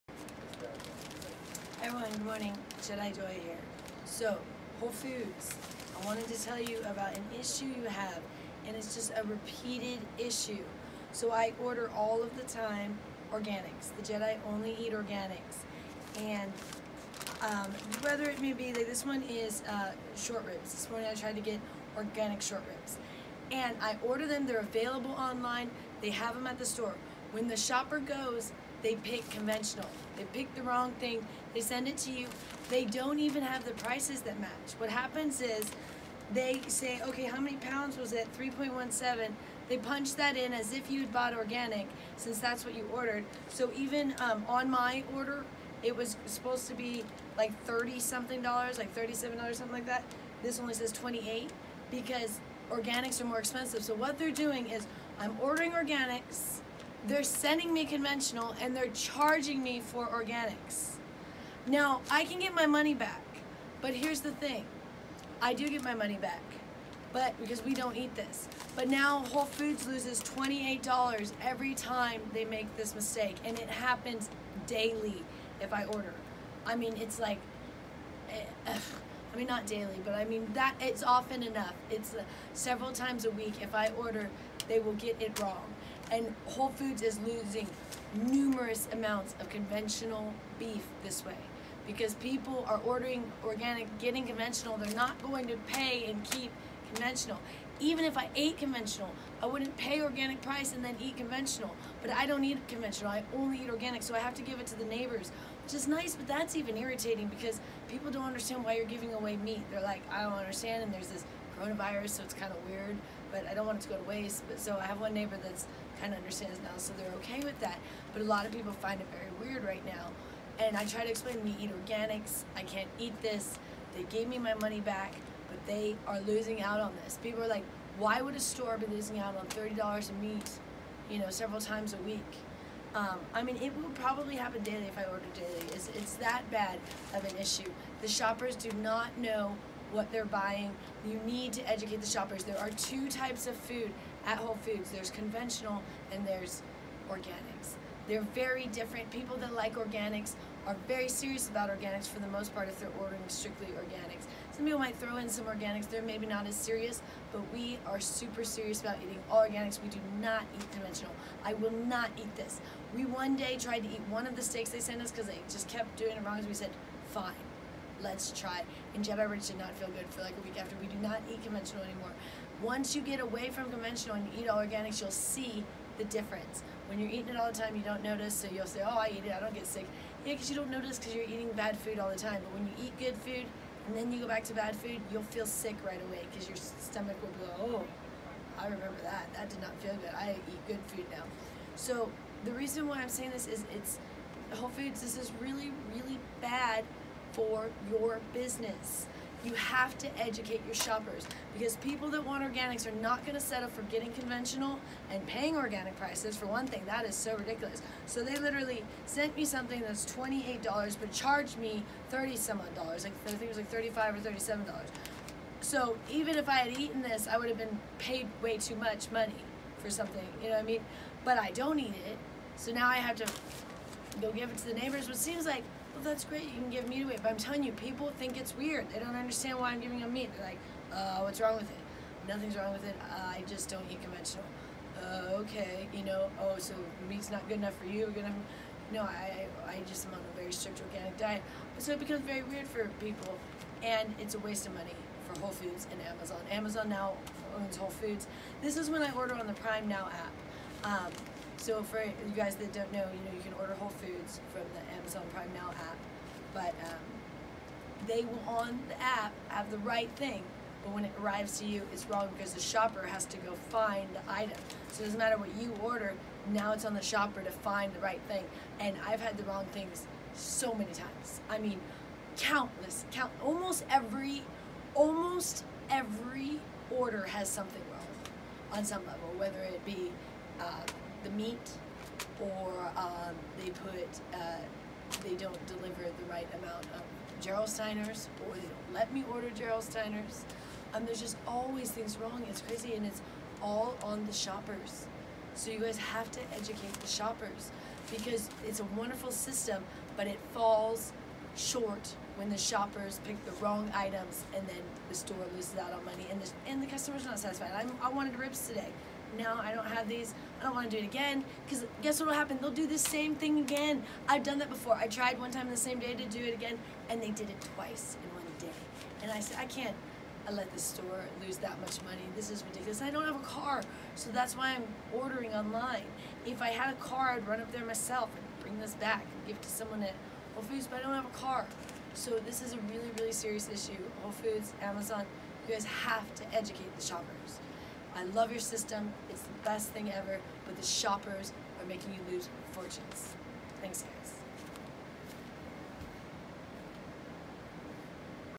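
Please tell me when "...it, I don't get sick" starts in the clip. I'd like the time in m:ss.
2:59.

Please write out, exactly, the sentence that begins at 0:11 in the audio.
So I order all of the time organics.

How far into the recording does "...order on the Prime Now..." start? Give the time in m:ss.
4:09.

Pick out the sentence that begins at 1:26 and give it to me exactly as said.
And Whole Foods is losing numerous amounts of conventional beef this way because people are ordering organic, getting conventional.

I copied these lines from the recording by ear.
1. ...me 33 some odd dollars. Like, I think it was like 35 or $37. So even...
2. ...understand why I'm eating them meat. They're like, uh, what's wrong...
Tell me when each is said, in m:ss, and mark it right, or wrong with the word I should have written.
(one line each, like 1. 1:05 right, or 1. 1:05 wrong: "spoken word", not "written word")
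1. 3:31 wrong: "30", not "33"
2. 3:49 wrong: "giving", not "eating".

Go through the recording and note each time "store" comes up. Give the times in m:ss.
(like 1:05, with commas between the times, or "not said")
0:26, 2:08, 5:05, 5:20.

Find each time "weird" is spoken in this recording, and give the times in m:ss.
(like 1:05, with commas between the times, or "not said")
1:52, 1:59, 3:48, 4:02.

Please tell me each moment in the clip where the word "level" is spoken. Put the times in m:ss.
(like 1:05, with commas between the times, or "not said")
4:39.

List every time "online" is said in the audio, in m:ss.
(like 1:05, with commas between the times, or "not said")
0:25, 5:25.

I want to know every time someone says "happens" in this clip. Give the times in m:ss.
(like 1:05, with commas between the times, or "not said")
0:34, 1:13, 2:14, 5:12.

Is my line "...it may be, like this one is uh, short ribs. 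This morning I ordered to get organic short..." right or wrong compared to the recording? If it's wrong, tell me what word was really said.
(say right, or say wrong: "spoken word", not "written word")
wrong: "tried", not "ordered".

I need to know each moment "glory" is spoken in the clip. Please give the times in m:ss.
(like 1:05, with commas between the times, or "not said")
not said.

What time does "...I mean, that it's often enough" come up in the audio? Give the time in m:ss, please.
1:20.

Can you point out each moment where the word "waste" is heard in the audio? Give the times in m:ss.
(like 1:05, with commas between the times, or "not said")
1:54, 4:04.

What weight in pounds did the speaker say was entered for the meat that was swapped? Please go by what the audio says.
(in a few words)
3.17.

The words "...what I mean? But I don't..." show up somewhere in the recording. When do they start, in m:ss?
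3:40.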